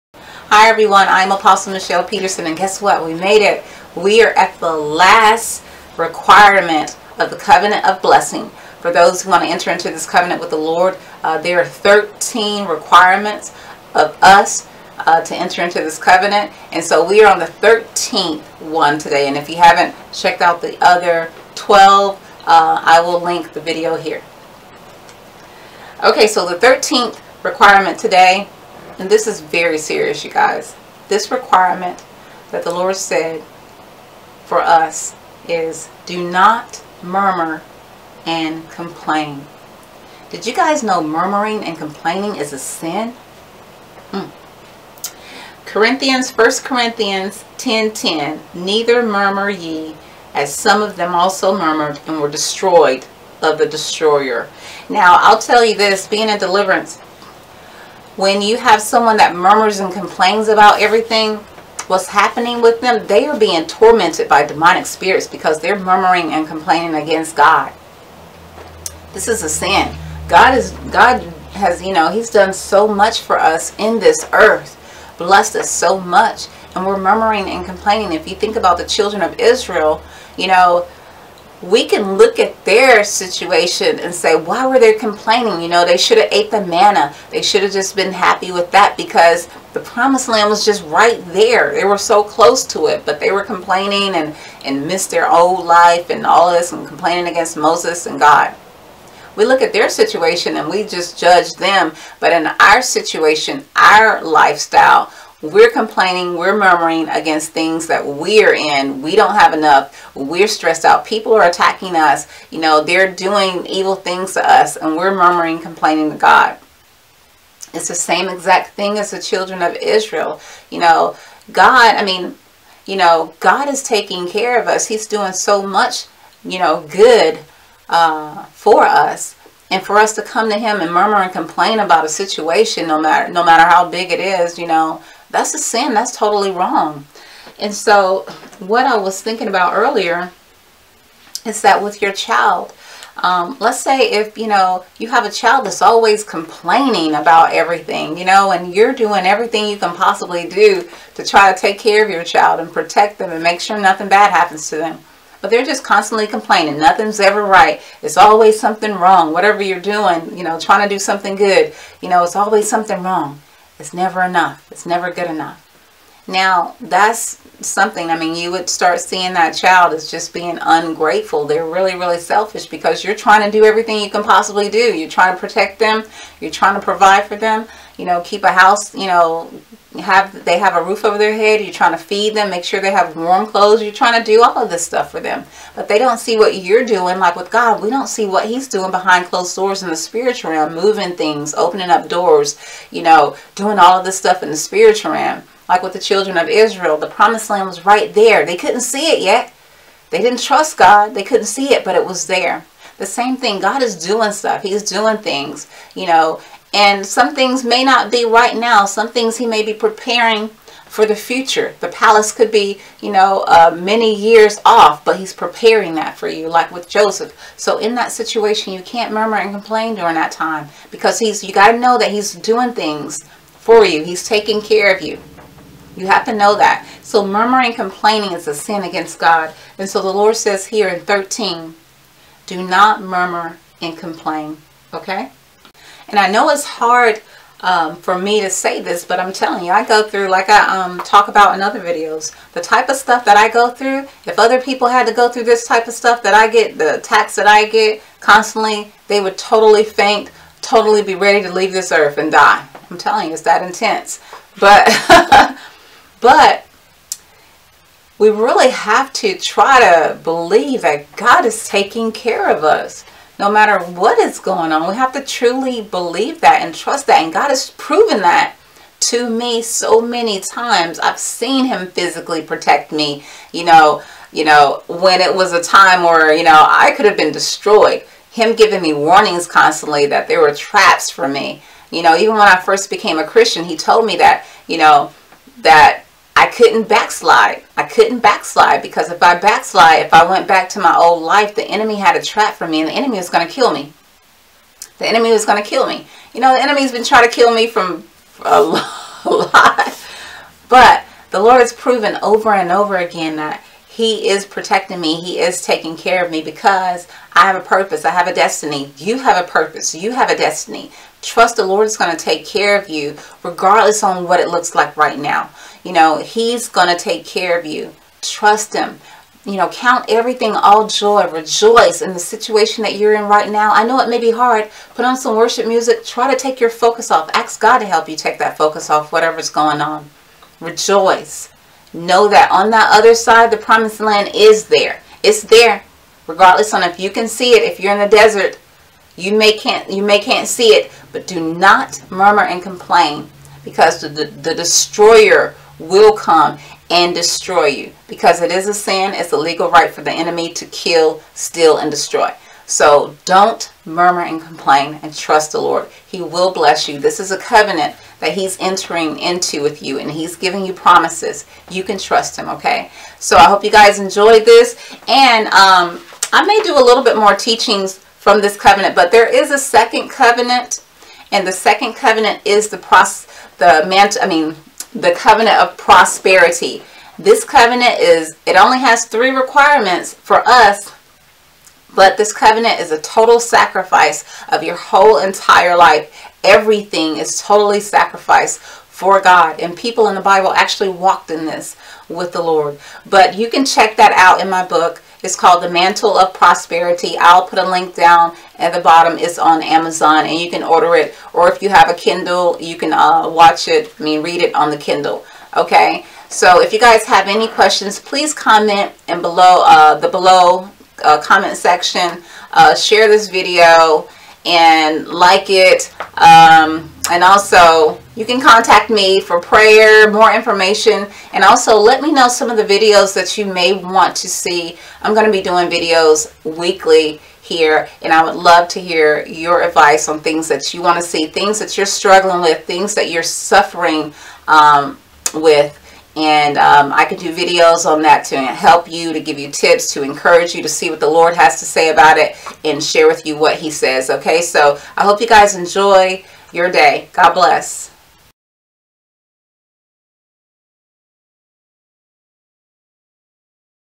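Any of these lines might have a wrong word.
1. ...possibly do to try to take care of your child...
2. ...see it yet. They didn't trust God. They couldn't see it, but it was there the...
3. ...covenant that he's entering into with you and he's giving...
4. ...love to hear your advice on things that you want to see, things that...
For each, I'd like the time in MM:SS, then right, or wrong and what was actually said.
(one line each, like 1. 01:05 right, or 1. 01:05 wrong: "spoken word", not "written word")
1. 02:29 right
2. 03:18 right
3. 05:57 right
4. 07:08 right.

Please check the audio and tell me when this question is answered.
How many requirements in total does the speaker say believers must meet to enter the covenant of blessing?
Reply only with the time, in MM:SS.
00:11.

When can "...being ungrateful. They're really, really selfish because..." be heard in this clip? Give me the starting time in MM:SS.
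02:50.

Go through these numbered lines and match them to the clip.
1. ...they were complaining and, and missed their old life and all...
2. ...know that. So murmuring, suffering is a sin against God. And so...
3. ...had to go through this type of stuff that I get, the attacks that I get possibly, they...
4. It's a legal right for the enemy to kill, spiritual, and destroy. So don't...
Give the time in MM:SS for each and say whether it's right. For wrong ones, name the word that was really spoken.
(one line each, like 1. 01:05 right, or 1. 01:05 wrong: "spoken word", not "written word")
1. 01:33 right
2. 03:46 wrong: "complaining", not "suffering"
3. 04:04 wrong: "constantly", not "possibly"
4. 05:49 wrong: "steal", not "spiritual".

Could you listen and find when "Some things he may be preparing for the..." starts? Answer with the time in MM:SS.
03:28.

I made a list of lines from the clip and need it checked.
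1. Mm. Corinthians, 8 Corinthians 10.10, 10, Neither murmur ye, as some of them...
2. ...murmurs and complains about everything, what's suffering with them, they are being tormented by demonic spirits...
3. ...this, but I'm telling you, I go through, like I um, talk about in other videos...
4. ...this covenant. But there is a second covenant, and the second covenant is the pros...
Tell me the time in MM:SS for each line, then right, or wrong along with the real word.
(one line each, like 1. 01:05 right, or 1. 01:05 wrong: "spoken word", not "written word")
1. 00:44 wrong: "1", not "8"
2. 00:59 wrong: "happening", not "suffering"
3. 03:58 right
4. 06:08 right.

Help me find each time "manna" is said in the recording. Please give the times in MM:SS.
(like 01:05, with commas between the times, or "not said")
01:26.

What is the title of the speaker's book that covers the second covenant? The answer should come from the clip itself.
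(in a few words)
The Mantle of Prosperity.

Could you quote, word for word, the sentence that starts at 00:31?
This requirement that the Lord said for us is do not murmur and complain.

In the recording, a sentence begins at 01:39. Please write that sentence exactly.
We look at their situation and we just judge them.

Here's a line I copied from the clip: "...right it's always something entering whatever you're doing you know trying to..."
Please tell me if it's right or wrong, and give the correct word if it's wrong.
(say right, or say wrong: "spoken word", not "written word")
wrong: "wrong", not "entering".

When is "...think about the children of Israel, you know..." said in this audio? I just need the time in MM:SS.
01:18.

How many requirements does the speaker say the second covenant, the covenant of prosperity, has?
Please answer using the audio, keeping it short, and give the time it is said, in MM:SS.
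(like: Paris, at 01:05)
3, at 06:19.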